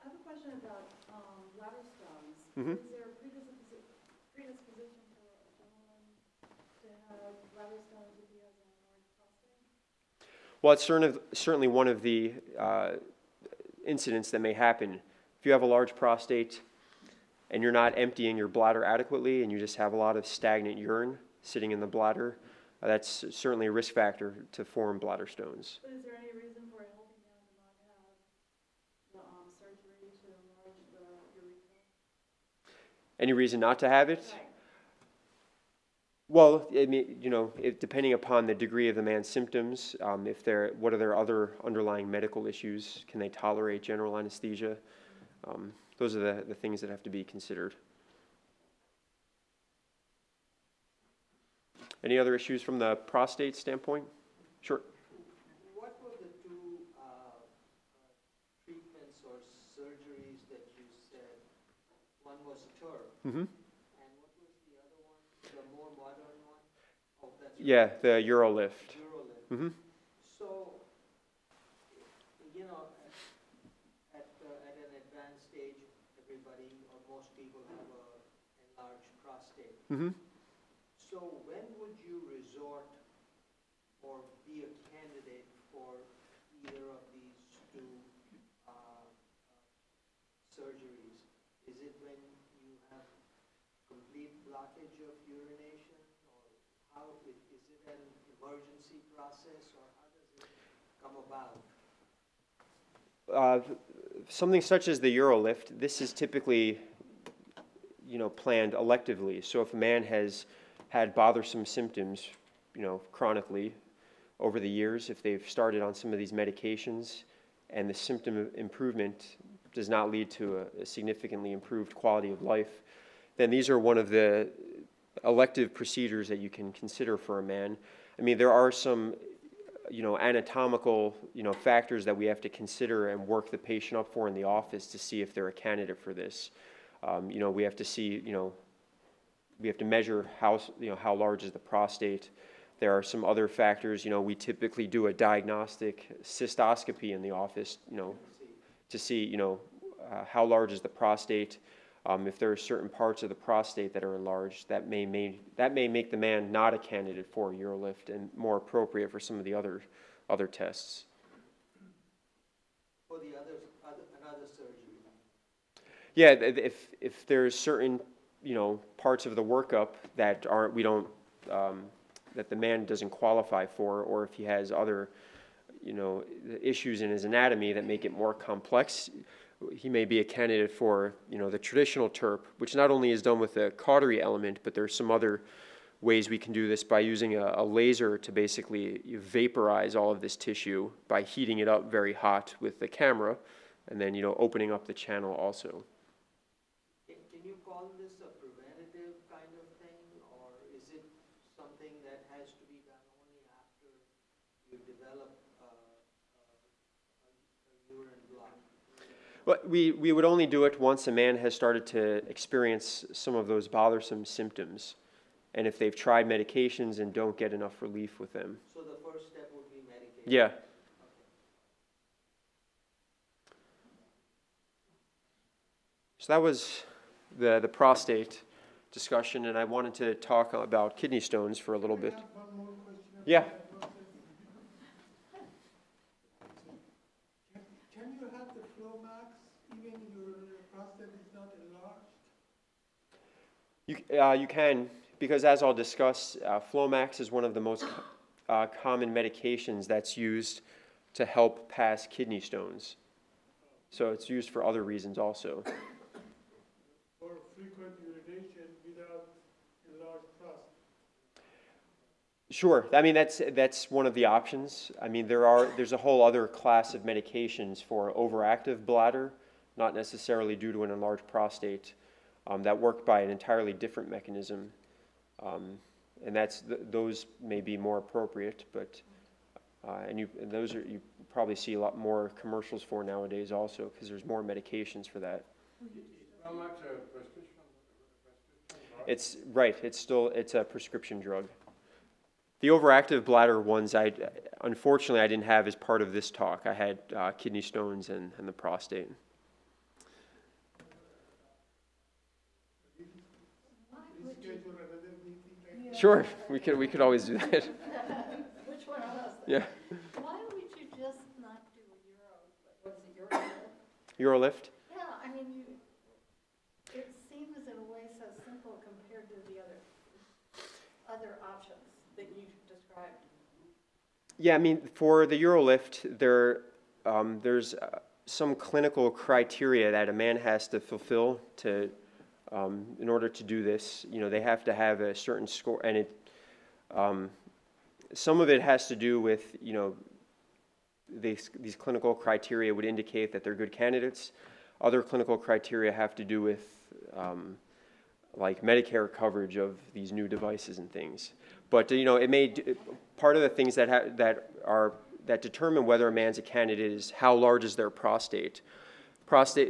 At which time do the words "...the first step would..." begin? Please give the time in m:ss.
3:38.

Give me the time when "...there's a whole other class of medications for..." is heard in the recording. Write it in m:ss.
4:25.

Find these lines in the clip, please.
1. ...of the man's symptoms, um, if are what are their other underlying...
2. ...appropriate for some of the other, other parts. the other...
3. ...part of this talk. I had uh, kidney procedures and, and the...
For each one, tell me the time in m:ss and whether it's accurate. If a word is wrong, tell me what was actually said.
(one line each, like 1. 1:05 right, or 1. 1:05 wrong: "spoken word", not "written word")
1. 0:38 right
2. 2:38 wrong: "tests", not "parts"
3. 4:55 wrong: "stones", not "procedures".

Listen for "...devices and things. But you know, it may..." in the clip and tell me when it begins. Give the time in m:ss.
5:50.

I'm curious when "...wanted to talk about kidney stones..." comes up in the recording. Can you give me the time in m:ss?
3:49.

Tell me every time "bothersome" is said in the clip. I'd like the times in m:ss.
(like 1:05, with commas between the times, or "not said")
1:51, 3:33.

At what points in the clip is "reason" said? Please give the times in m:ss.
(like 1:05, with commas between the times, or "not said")
0:33, 4:14.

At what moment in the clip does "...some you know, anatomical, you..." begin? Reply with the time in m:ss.
2:08.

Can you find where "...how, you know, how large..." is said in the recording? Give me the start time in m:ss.
2:20.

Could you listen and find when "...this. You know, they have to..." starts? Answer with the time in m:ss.
5:33.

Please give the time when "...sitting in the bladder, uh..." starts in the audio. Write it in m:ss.
0:21.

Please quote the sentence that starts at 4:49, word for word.
It's, right, it's still, it's a prescription drug.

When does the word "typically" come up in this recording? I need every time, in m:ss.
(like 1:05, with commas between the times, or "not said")
1:46, 2:24.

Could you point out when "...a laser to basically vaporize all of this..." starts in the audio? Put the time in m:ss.
3:07.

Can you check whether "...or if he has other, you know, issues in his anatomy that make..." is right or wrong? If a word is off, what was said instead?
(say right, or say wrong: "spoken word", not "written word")
right.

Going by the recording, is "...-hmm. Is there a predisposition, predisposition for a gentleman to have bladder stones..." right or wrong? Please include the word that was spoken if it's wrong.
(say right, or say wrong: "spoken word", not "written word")
right.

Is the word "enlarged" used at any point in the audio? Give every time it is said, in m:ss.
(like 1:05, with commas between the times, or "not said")
1:18, 2:34, 4:01, 4:30.